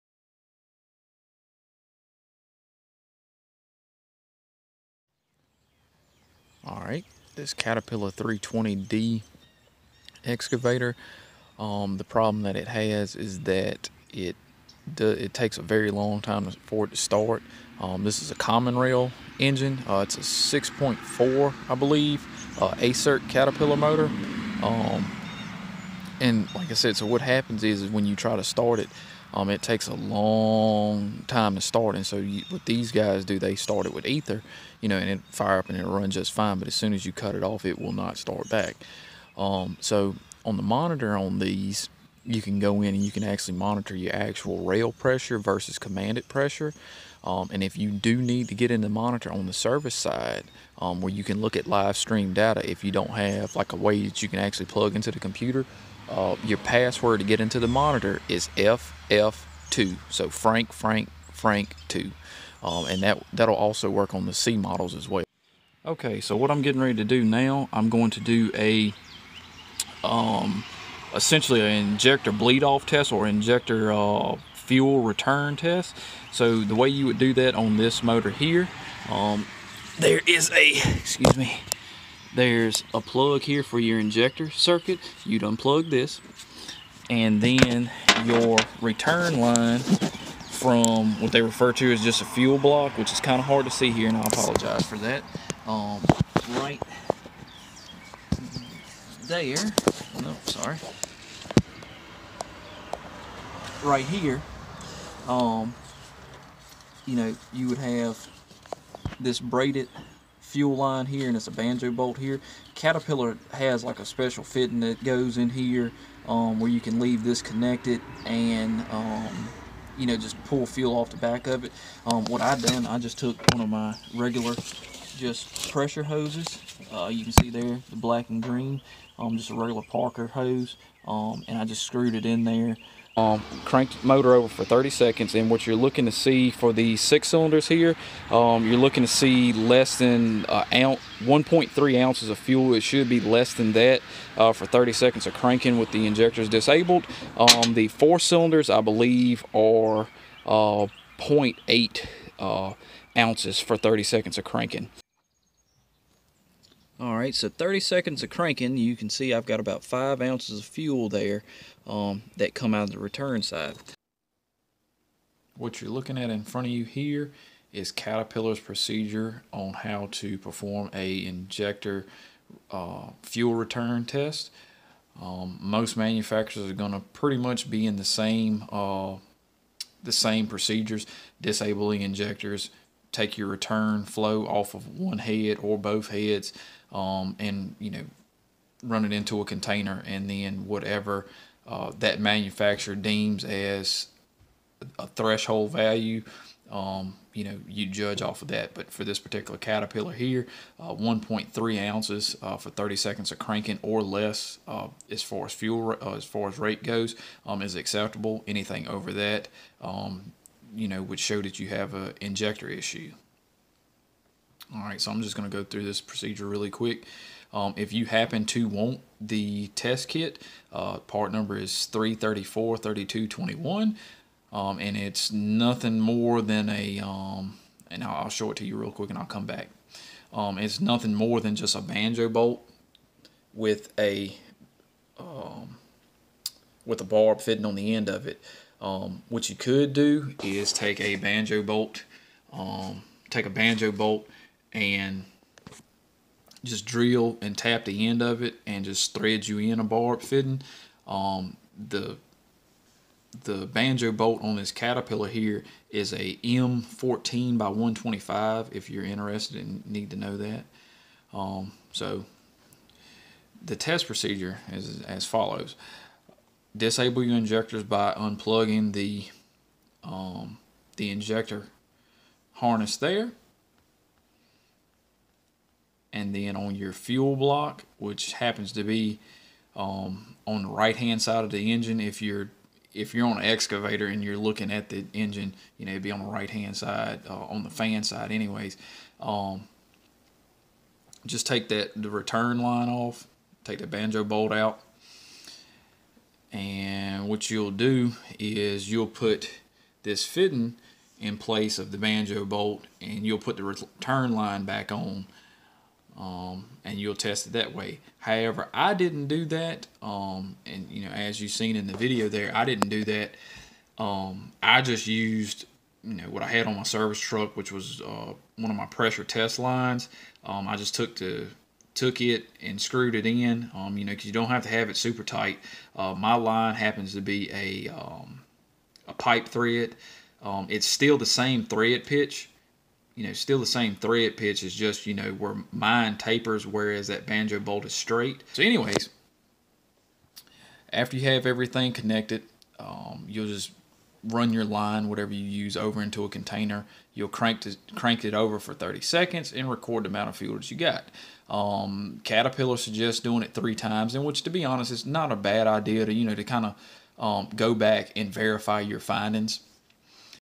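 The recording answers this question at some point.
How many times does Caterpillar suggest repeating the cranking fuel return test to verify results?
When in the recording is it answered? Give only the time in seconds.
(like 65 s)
353 s.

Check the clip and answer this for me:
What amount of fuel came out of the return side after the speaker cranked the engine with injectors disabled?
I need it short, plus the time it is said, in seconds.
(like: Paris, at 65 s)
about 5 ounces, at 159 s.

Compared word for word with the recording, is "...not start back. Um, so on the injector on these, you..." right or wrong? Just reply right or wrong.
wrong.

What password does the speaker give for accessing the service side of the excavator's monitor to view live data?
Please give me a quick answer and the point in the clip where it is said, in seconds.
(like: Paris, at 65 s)
FF2, at 58 s.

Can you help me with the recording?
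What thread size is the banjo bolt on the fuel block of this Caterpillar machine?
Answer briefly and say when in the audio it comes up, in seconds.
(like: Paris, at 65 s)
M14 x 1.25, at 256 s.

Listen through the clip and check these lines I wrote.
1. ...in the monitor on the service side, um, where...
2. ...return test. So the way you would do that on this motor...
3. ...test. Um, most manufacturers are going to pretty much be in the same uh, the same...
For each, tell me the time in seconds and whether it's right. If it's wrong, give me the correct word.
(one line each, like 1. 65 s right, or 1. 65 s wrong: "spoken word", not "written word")
1. 48 s right
2. 75 s right
3. 174 s right.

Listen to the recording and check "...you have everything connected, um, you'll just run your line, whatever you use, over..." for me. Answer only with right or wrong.
right.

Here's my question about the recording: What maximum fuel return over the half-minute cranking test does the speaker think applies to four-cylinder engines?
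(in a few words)
0.8 ounces.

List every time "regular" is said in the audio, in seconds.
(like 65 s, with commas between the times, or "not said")
124 s, 129 s.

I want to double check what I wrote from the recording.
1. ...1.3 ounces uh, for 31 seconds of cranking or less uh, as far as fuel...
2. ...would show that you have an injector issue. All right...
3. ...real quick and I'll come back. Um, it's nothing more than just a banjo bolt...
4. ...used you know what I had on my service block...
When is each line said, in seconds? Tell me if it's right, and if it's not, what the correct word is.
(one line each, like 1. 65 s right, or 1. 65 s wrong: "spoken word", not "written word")
1. 200 s wrong: "30", not "31"
2. 211 s right
3. 228 s right
4. 315 s wrong: "truck", not "block".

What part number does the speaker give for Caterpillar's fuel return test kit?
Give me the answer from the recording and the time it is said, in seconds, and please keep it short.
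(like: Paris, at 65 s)
3343221, at 221 s.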